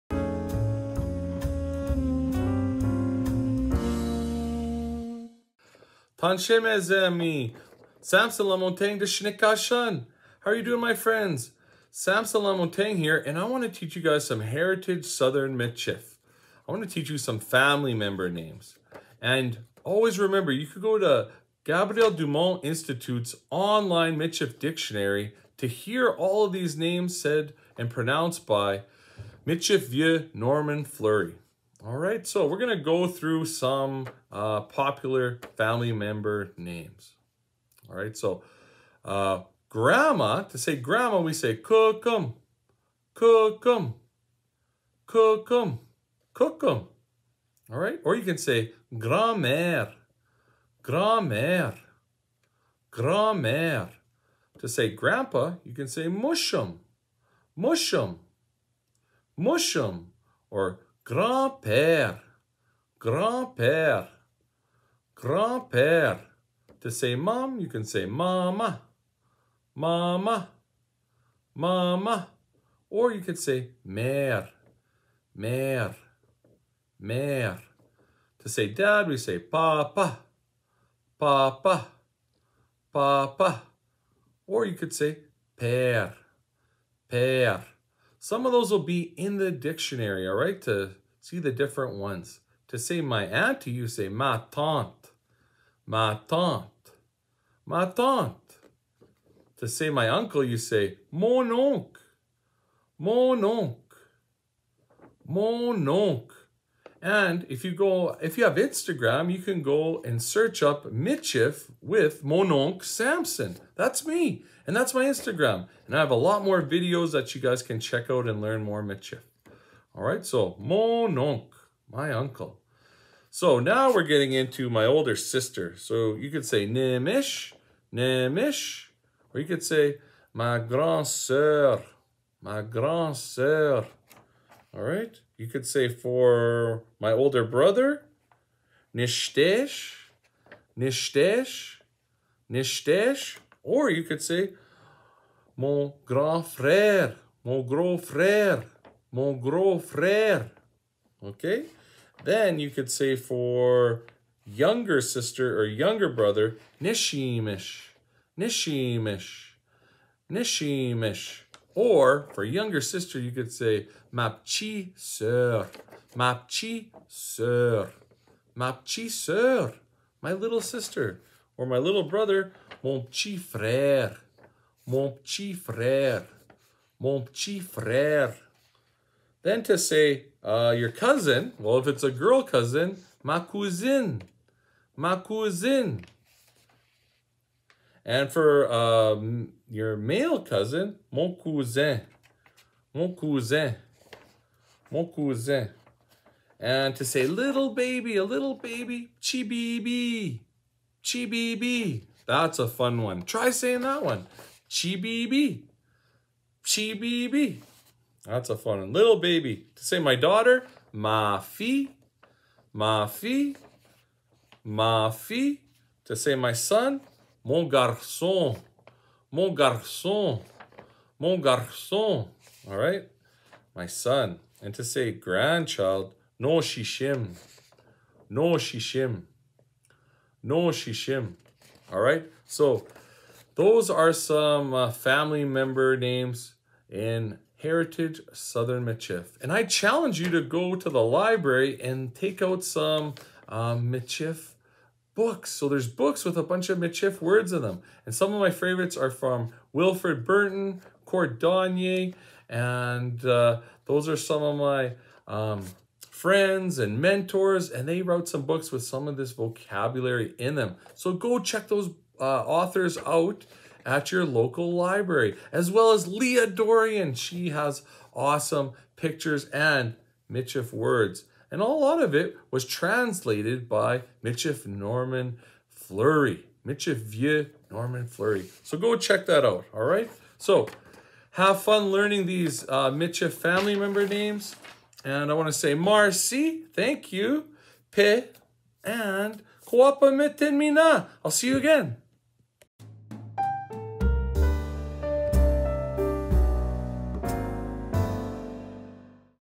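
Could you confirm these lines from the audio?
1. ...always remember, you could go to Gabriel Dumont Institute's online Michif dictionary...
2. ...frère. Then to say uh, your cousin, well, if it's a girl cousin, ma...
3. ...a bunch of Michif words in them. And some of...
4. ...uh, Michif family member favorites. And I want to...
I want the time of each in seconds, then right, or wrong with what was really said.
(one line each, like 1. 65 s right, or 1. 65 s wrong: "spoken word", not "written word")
1. 19 s right
2. 177 s right
3. 246 s right
4. 282 s wrong: "names", not "favorites".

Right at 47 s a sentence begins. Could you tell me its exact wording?
All right, or you can say grand-mère, grand-mère, grand-mère.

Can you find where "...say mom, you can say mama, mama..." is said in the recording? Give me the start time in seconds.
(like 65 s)
66 s.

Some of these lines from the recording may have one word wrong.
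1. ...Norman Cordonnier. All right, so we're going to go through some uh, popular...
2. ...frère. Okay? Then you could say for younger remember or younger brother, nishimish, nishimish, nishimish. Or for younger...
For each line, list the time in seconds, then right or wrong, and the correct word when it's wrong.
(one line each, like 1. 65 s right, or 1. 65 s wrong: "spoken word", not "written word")
1. 30 s wrong: "Fleury", not "Cordonnier"
2. 149 s wrong: "sister", not "remember".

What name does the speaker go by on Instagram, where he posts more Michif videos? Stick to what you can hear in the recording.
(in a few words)
Michif with Mononk Samson.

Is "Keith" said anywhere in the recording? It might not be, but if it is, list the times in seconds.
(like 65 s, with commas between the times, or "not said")
not said.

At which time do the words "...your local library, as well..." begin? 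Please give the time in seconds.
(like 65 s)
264 s.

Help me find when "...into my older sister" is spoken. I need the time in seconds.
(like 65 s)
124 s.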